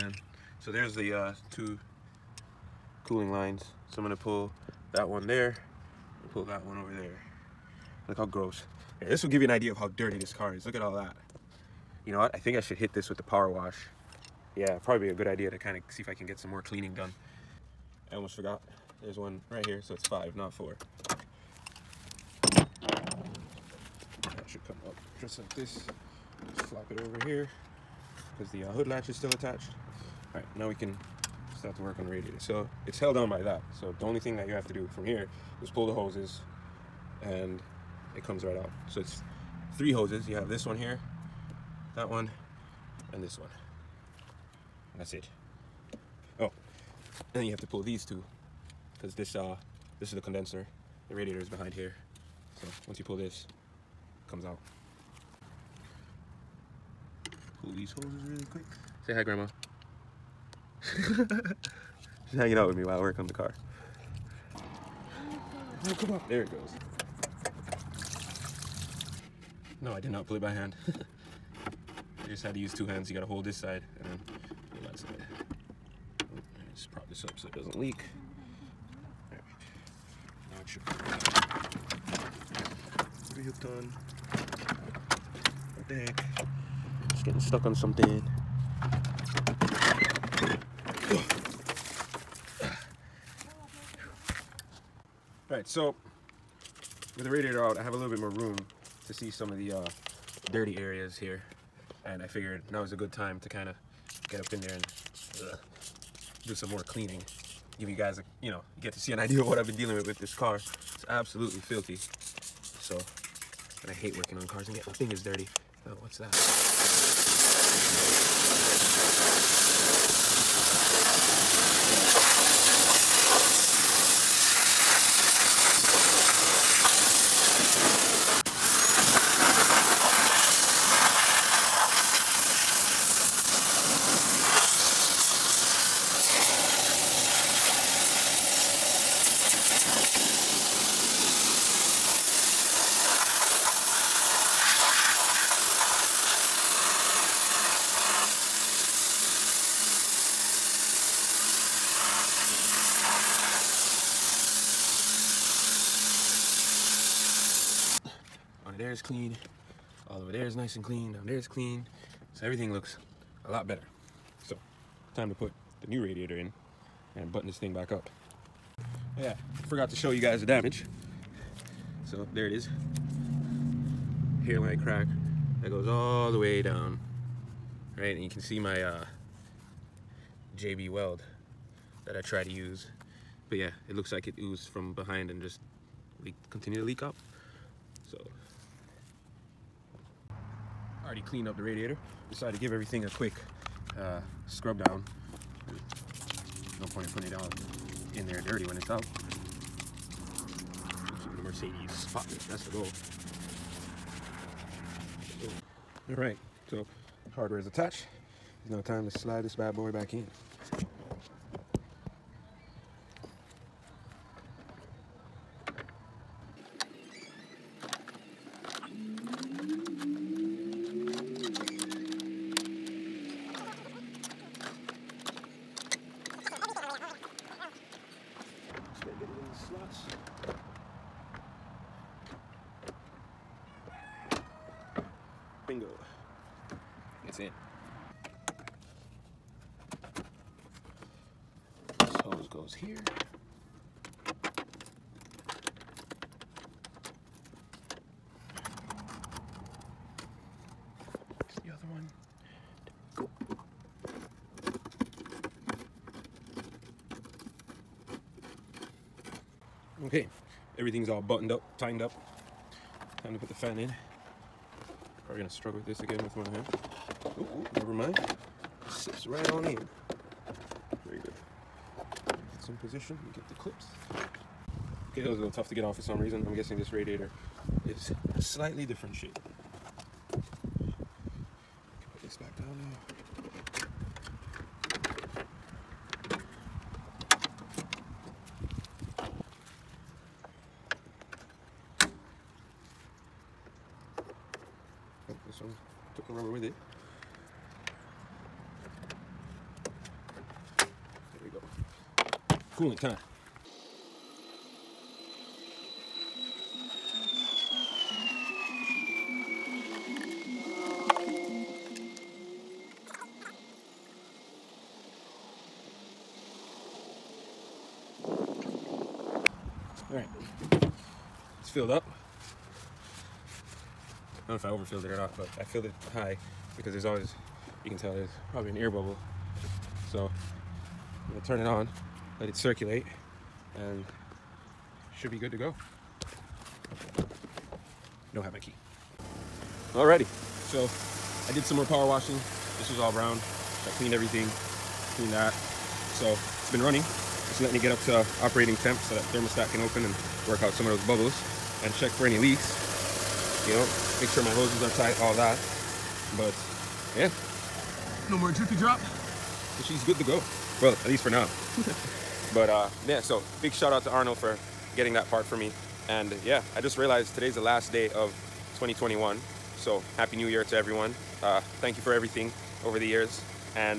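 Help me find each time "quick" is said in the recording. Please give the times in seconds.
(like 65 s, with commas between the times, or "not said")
58 s, 193 s.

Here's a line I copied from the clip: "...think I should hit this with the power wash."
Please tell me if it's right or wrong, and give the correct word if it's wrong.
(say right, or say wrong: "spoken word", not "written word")
right.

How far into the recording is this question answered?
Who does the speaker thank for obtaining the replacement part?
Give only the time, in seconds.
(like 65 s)
364 s.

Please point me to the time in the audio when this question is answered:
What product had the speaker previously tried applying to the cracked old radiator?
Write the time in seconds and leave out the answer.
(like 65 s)
180 s.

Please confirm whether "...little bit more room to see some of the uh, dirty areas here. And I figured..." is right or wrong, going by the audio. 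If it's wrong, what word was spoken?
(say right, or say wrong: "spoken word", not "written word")
right.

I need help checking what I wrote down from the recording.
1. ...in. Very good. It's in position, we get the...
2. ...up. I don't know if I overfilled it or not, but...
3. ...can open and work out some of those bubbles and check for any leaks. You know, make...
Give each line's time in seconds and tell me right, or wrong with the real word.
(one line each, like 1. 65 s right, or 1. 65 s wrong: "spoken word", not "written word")
1. 269 s right
2. 321 s right
3. 349 s right.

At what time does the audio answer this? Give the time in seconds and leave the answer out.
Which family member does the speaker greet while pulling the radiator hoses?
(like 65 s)
59 s.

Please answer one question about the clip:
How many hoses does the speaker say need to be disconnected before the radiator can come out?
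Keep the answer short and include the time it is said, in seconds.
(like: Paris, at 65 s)
3, at 39 s.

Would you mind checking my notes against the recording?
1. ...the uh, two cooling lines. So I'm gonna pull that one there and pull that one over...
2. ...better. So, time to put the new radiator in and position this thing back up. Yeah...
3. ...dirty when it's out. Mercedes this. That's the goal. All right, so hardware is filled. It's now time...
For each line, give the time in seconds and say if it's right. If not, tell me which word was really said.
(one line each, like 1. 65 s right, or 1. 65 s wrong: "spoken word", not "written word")
1. 0 s right
2. 163 s wrong: "button", not "position"
3. 198 s wrong: "attached", not "filled".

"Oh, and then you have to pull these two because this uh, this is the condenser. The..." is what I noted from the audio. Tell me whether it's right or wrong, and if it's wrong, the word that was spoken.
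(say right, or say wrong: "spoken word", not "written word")
right.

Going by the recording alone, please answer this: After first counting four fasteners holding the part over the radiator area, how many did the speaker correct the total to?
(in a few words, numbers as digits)
5.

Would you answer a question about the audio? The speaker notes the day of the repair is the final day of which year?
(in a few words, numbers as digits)
2021.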